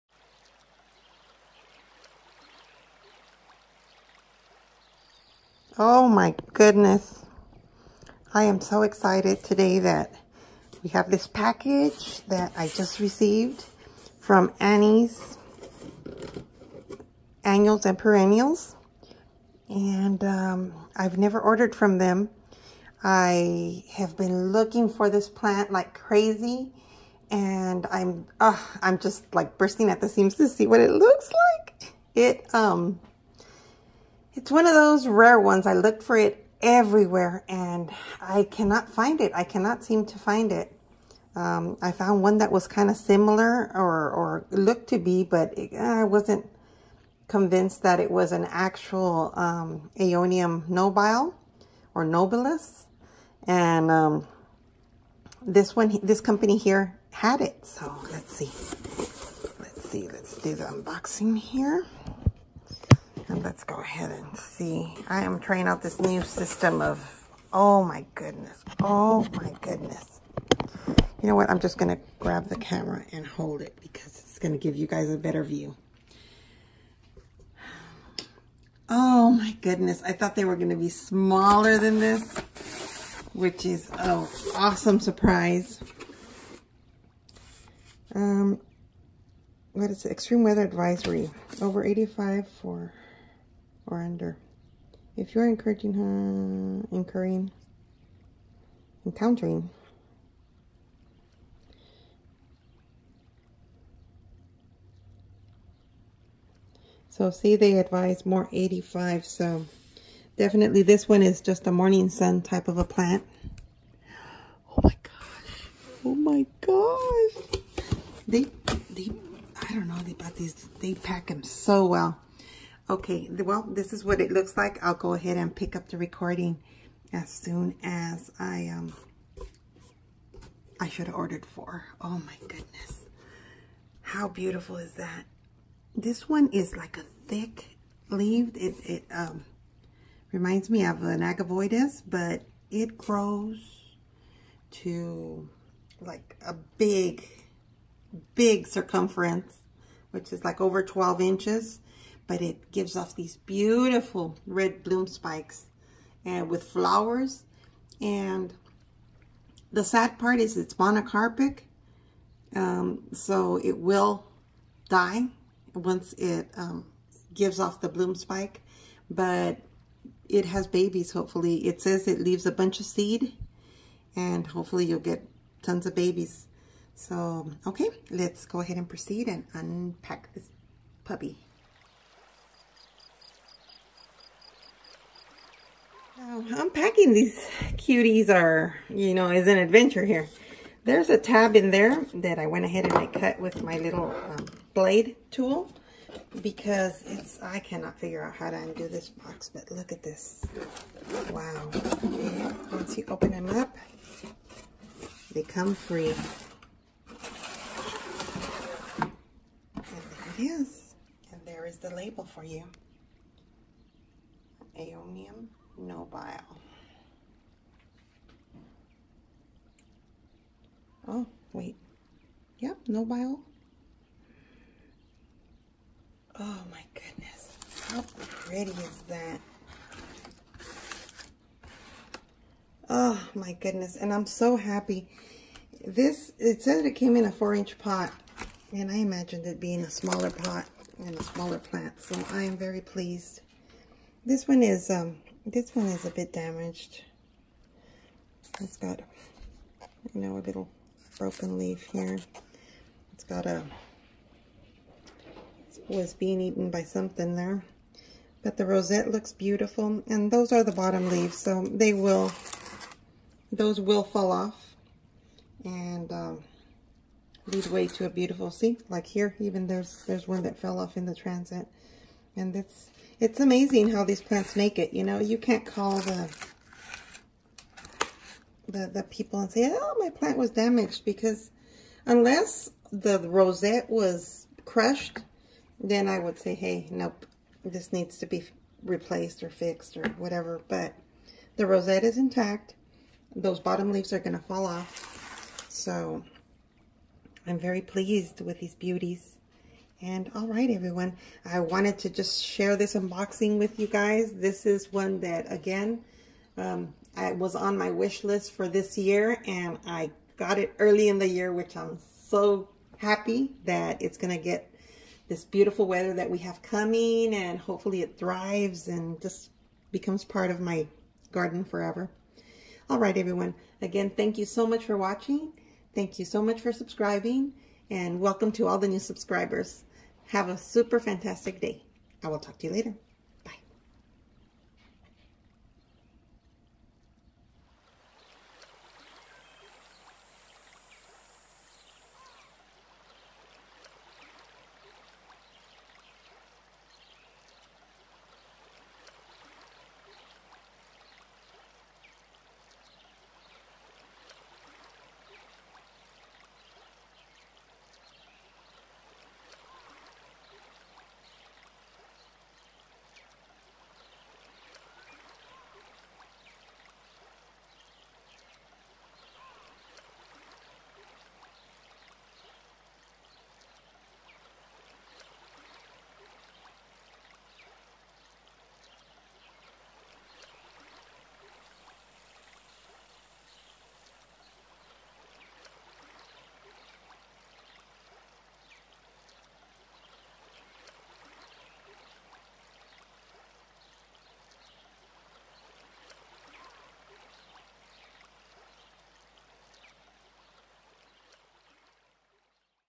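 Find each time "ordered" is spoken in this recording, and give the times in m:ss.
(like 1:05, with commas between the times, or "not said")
0:21, 2:11.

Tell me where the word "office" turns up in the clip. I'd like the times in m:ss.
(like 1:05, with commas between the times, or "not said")
not said.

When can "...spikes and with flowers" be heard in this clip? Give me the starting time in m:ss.
2:35.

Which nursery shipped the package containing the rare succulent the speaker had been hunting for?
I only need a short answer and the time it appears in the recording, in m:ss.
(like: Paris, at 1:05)
Annie's Annuals and Perennials, at 0:14.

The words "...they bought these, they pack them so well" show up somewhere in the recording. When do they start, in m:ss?
2:00.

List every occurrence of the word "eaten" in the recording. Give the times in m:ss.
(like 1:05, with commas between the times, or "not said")
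4:16.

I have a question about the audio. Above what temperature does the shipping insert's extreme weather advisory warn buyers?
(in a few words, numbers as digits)
85.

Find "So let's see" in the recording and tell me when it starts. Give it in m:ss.
0:57.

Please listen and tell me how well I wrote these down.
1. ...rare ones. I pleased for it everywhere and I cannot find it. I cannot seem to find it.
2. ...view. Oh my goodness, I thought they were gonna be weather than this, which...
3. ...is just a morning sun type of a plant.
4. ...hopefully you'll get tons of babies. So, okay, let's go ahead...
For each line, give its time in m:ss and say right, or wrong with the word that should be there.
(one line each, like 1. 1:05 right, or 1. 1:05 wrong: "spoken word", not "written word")
1. 0:35 wrong: "looked", not "pleased"
2. 1:15 wrong: "smaller", not "weather"
3. 1:51 right
4. 2:54 right.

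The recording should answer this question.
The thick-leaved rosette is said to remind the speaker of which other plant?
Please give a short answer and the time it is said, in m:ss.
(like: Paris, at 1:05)
agavoides, at 2:21.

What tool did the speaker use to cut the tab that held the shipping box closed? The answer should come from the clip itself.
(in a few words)
blade tool.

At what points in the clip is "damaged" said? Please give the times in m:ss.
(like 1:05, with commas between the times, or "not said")
4:06, 4:40.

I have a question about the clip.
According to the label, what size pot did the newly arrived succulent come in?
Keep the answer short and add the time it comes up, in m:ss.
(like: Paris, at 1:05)
4 inch, at 3:57.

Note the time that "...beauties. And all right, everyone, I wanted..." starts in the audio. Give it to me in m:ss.
4:58.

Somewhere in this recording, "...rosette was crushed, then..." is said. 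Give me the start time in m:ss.
4:43.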